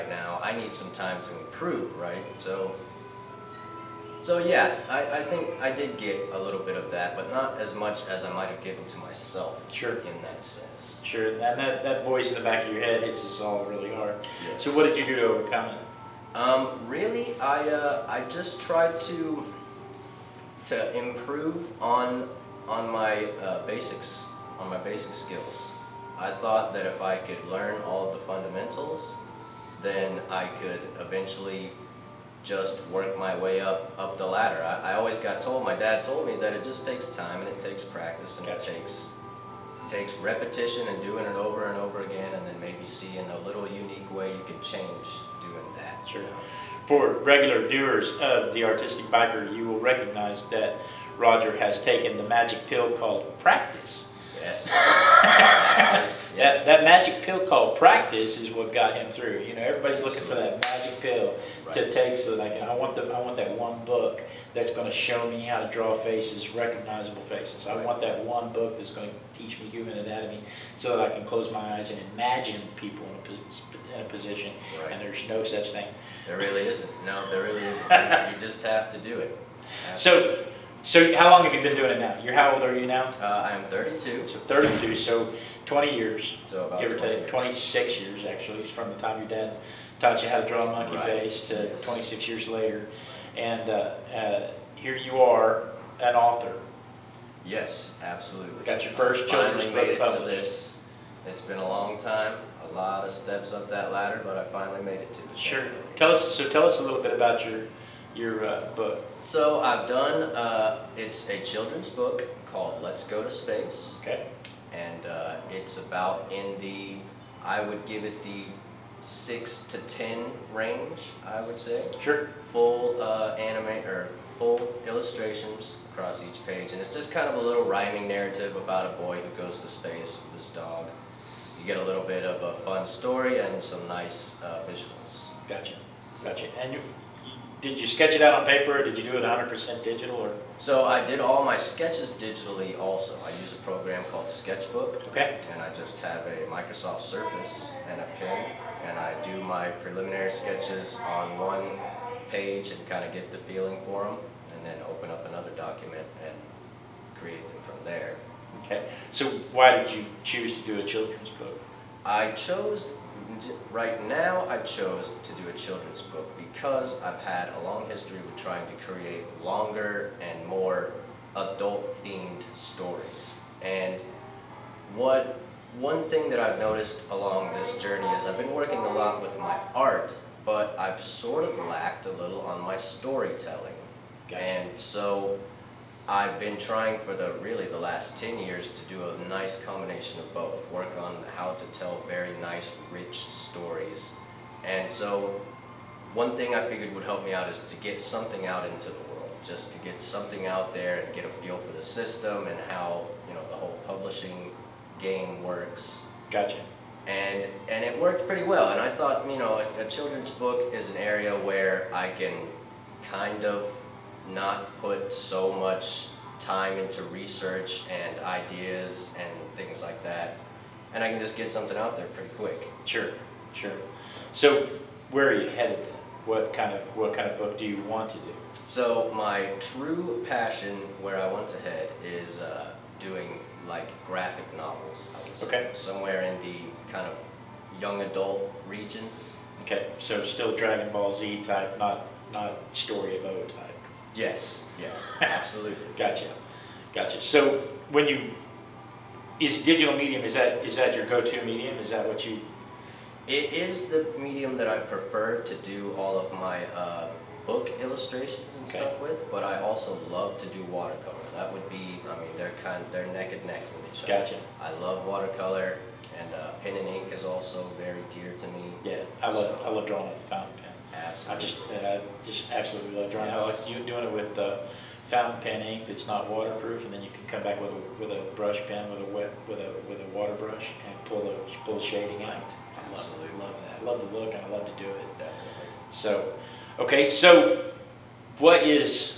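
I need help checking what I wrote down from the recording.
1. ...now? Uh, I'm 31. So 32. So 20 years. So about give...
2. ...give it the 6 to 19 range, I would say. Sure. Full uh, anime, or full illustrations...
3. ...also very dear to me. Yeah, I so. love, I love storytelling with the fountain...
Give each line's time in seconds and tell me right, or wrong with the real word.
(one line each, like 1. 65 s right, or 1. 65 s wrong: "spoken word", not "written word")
1. 82 s wrong: "32", not "31"
2. 117 s wrong: "10", not "19"
3. 267 s wrong: "drawing", not "storytelling".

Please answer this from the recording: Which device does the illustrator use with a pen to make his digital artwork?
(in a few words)
Microsoft Surface.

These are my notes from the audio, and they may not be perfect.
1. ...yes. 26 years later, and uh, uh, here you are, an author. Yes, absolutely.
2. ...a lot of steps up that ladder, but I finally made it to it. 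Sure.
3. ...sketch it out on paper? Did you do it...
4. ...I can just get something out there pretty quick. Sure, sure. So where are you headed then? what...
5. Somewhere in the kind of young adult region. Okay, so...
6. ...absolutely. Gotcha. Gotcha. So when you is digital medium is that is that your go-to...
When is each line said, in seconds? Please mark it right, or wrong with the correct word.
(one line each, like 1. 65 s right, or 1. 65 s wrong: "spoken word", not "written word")
1. 91 s right
2. 102 s right
3. 137 s right
4. 221 s right
5. 235 s right
6. 245 s right.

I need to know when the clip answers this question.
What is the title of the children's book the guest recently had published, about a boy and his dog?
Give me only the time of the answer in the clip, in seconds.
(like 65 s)
112 s.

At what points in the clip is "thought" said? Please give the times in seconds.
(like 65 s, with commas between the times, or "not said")
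26 s, 208 s.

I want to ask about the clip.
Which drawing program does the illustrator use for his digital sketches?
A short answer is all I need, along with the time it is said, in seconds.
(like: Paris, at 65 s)
Sketchbook, at 144 s.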